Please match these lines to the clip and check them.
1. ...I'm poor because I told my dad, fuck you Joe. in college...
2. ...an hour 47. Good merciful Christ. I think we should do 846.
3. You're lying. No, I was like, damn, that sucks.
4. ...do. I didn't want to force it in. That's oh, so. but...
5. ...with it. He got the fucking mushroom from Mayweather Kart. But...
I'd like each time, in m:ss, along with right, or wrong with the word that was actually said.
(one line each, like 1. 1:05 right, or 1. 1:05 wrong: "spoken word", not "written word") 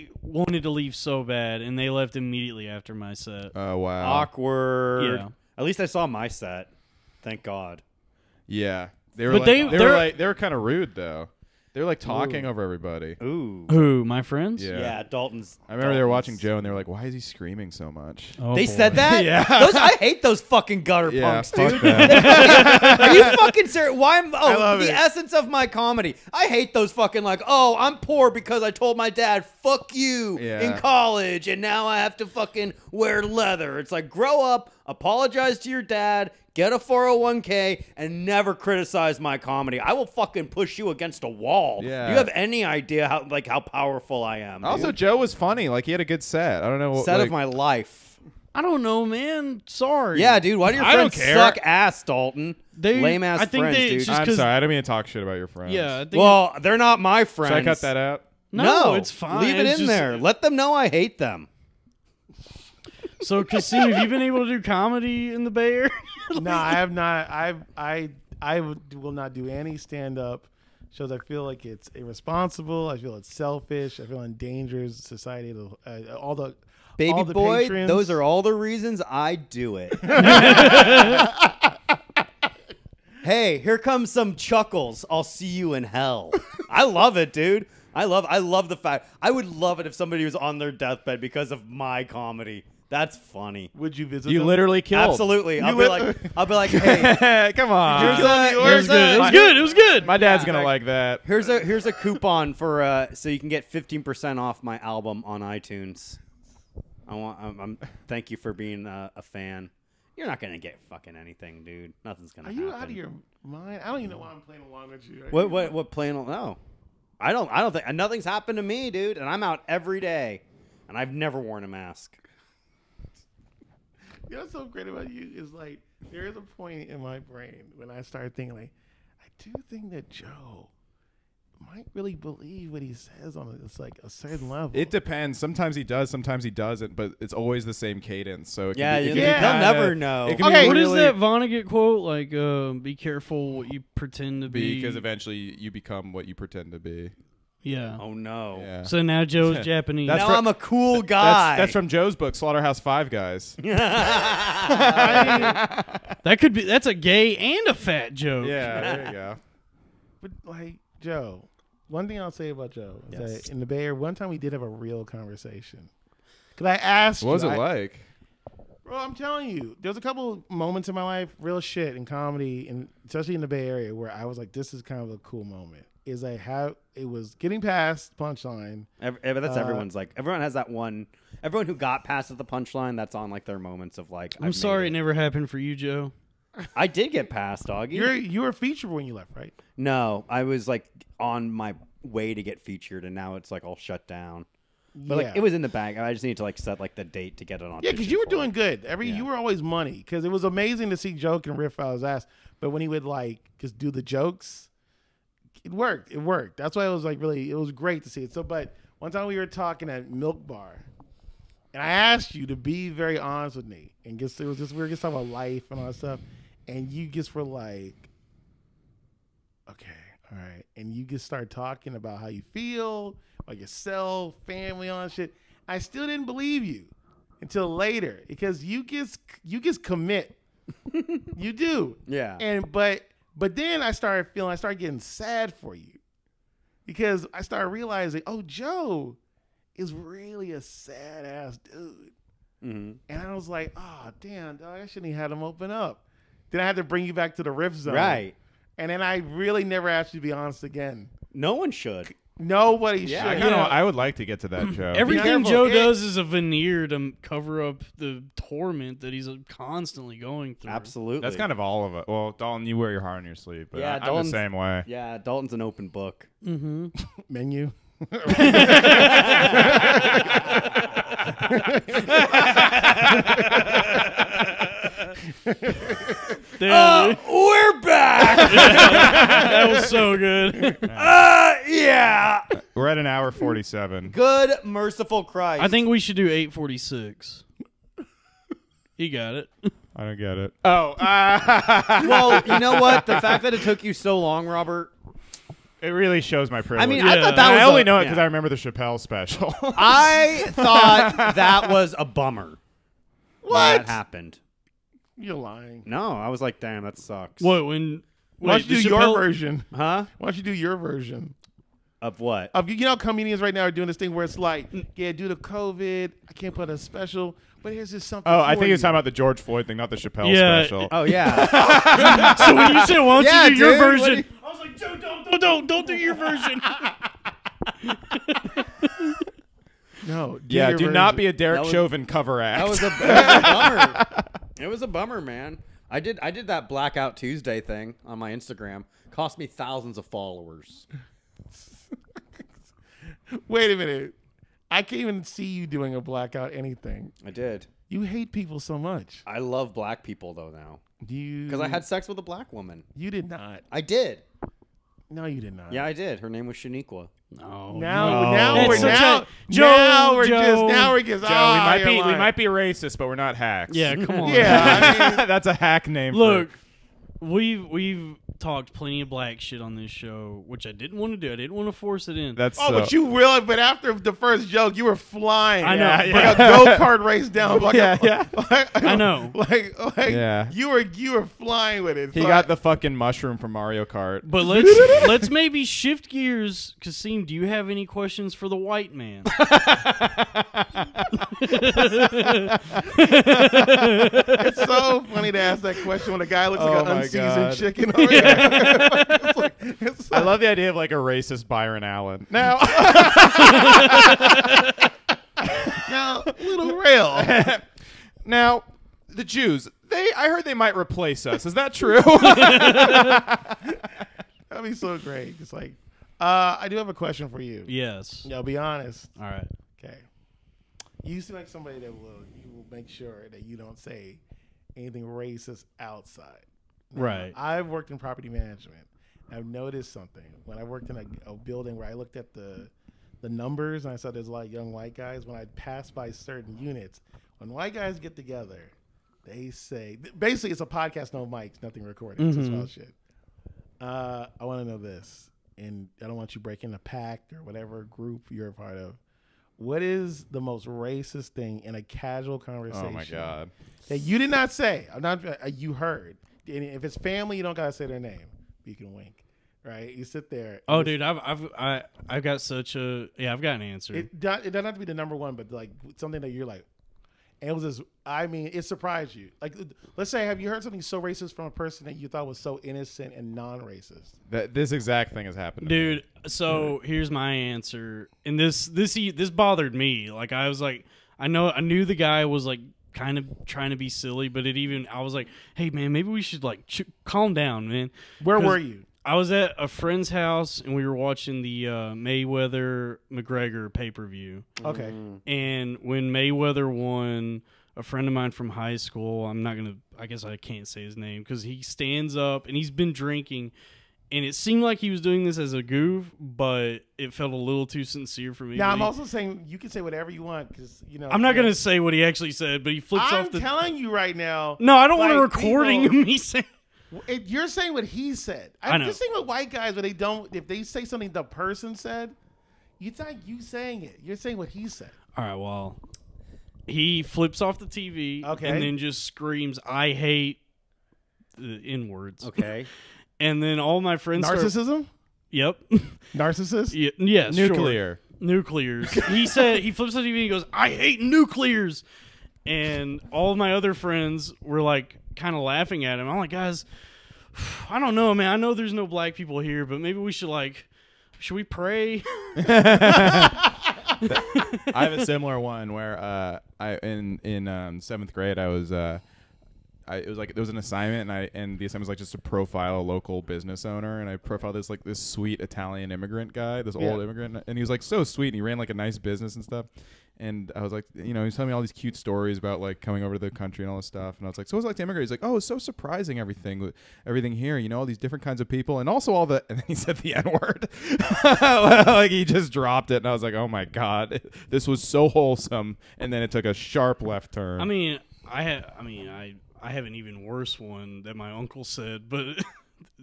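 1. 0:27 wrong: "Yeah", not "Joe"
2. 4:42 right
3. 5:05 right
4. 6:11 right
5. 6:21 wrong: "Mario", not "Mayweather".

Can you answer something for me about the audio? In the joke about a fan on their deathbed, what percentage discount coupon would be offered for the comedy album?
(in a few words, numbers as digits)
15 percent.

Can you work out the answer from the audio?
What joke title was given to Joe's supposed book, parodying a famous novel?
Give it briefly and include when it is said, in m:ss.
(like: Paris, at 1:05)
Slaughterhouse Five Guys, at 2:32.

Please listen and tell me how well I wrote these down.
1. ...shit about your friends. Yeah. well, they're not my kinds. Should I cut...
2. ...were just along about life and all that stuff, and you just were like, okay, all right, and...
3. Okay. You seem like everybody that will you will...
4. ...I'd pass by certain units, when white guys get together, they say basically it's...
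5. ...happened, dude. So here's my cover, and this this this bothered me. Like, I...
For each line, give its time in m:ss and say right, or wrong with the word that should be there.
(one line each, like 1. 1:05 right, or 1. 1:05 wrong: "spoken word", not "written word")
1. 0:55 wrong: "friends", not "kinds"
2. 3:34 wrong: "talking", not "along"
3. 6:59 wrong: "somebody", not "everybody"
4. 7:15 right
5. 7:55 wrong: "answer", not "cover".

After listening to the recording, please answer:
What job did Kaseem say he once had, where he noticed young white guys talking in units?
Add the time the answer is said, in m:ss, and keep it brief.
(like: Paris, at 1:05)
Property management, at 7:07.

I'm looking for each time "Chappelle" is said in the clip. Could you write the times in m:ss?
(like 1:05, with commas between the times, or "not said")
4:58, 5:19.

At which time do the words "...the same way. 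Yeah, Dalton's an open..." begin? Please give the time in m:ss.
4:24.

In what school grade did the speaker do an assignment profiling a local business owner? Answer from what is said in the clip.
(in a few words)
Seventh grade.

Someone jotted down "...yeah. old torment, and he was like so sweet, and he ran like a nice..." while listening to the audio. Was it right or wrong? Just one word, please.
wrong.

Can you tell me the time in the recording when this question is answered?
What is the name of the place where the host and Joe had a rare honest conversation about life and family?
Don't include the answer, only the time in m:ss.
3:30.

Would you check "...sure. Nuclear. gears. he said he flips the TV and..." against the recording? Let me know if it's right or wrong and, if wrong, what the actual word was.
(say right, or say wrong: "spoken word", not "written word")
wrong: "nuclears", not "gears".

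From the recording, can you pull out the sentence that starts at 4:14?
Everything Joe it, does is a veneer to cover up the torment that he's uh, constantly going through.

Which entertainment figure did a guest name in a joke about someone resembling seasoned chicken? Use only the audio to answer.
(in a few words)
Byron Allen.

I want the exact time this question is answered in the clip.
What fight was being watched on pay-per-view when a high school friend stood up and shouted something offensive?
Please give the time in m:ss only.
8:11.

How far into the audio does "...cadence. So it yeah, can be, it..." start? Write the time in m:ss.
2:18.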